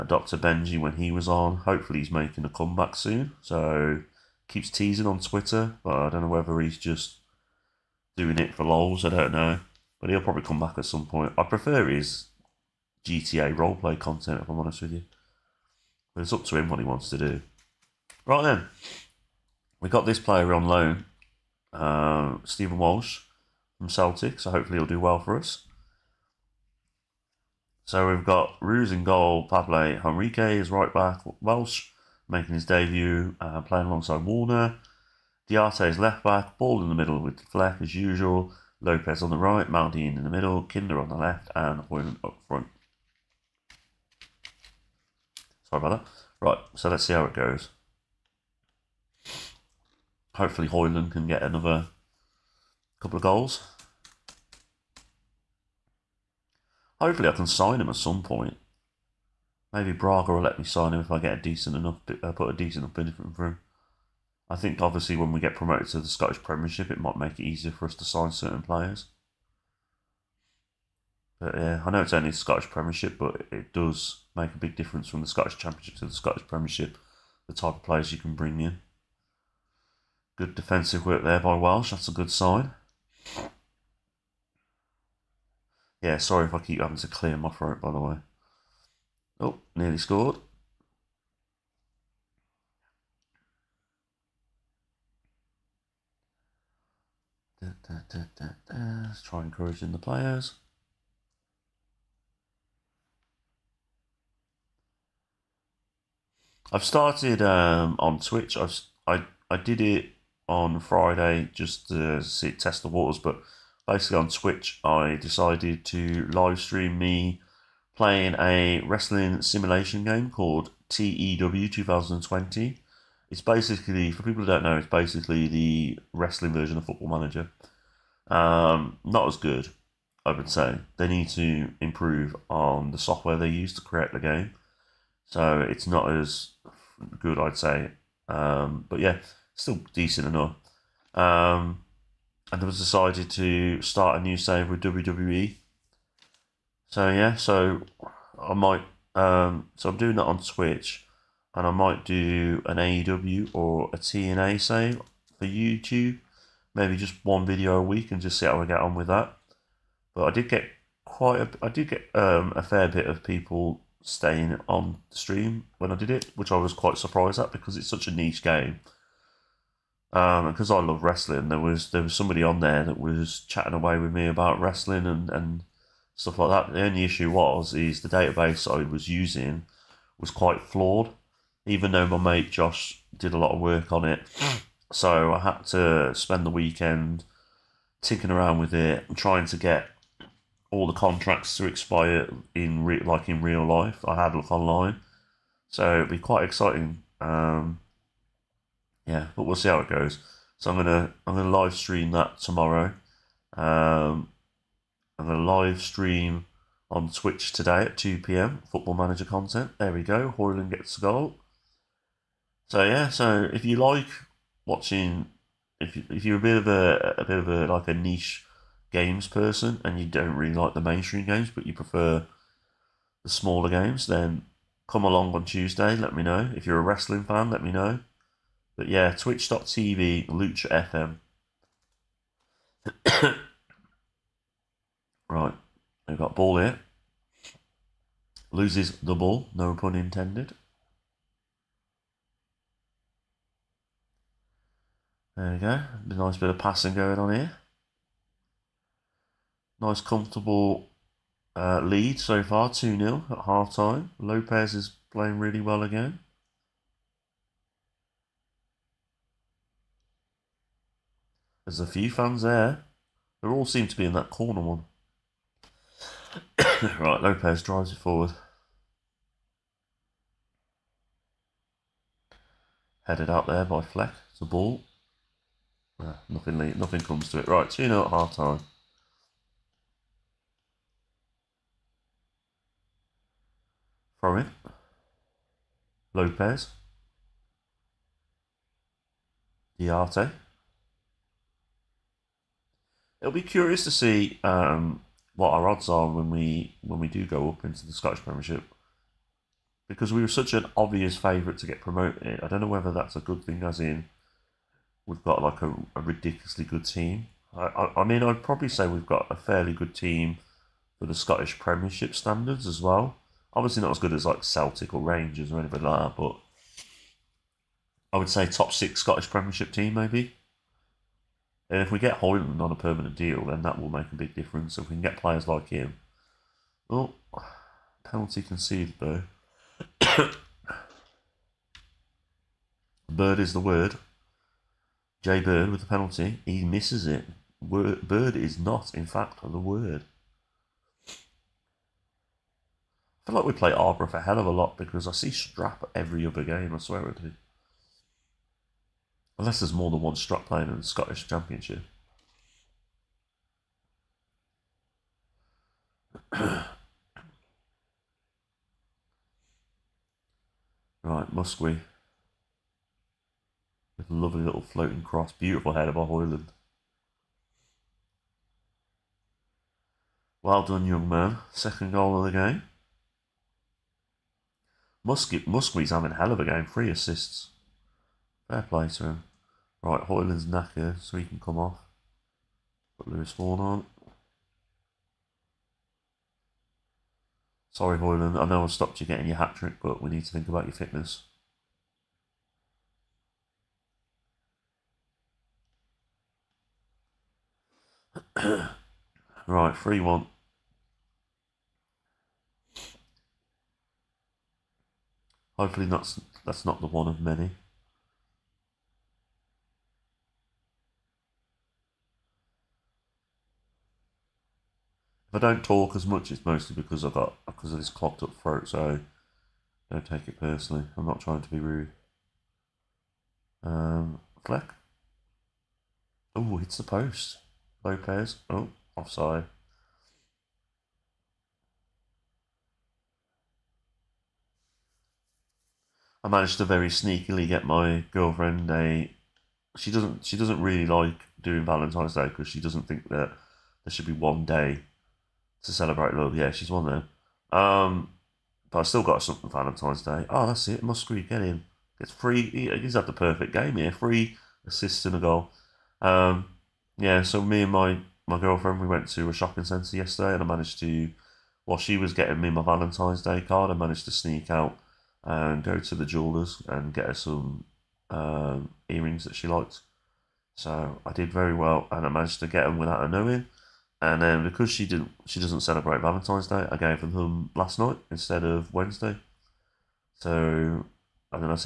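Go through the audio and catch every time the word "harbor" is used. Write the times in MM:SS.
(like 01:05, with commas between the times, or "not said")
not said.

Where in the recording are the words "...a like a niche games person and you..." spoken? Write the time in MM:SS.
03:37.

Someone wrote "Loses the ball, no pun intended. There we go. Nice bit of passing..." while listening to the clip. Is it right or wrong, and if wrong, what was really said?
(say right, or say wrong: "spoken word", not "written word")
right.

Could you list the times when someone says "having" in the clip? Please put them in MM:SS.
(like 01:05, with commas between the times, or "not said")
01:26, 06:15.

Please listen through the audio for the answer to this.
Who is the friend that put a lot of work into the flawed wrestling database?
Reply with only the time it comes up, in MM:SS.
03:02.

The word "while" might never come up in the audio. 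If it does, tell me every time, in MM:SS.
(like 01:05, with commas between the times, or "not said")
07:41.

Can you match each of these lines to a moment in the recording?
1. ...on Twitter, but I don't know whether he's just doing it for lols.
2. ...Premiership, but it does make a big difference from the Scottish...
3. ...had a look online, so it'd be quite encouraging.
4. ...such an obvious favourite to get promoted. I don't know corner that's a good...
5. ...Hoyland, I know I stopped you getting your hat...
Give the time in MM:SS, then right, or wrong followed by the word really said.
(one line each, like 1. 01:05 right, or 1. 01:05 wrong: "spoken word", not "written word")
1. 00:05 right
2. 01:12 right
3. 03:14 wrong: "exciting", not "encouraging"
4. 05:00 wrong: "whether", not "corner"
5. 06:27 right.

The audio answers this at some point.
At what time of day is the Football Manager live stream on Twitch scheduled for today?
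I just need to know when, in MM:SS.
03:27.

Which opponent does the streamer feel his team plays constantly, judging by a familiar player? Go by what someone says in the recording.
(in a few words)
Arbroath.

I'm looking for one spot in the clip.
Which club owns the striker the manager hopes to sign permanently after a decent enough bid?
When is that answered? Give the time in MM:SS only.
00:59.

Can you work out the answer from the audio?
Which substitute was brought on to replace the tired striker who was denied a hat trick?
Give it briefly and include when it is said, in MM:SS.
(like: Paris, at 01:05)
Lewis Vaughan, at 06:23.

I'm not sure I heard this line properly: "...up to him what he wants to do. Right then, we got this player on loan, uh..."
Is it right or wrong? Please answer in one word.
right.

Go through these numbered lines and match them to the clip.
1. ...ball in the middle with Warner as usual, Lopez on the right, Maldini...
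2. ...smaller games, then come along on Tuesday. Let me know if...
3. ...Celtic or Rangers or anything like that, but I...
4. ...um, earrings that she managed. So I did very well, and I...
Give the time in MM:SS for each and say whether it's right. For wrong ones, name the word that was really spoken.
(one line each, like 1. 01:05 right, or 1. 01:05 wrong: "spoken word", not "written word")
1. 00:36 wrong: "Fleck", not "Warner"
2. 03:43 right
3. 05:14 right
4. 07:48 wrong: "liked", not "managed".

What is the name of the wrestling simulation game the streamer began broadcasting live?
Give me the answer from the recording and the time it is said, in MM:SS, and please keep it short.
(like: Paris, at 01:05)
TEW 2020, at 02:00.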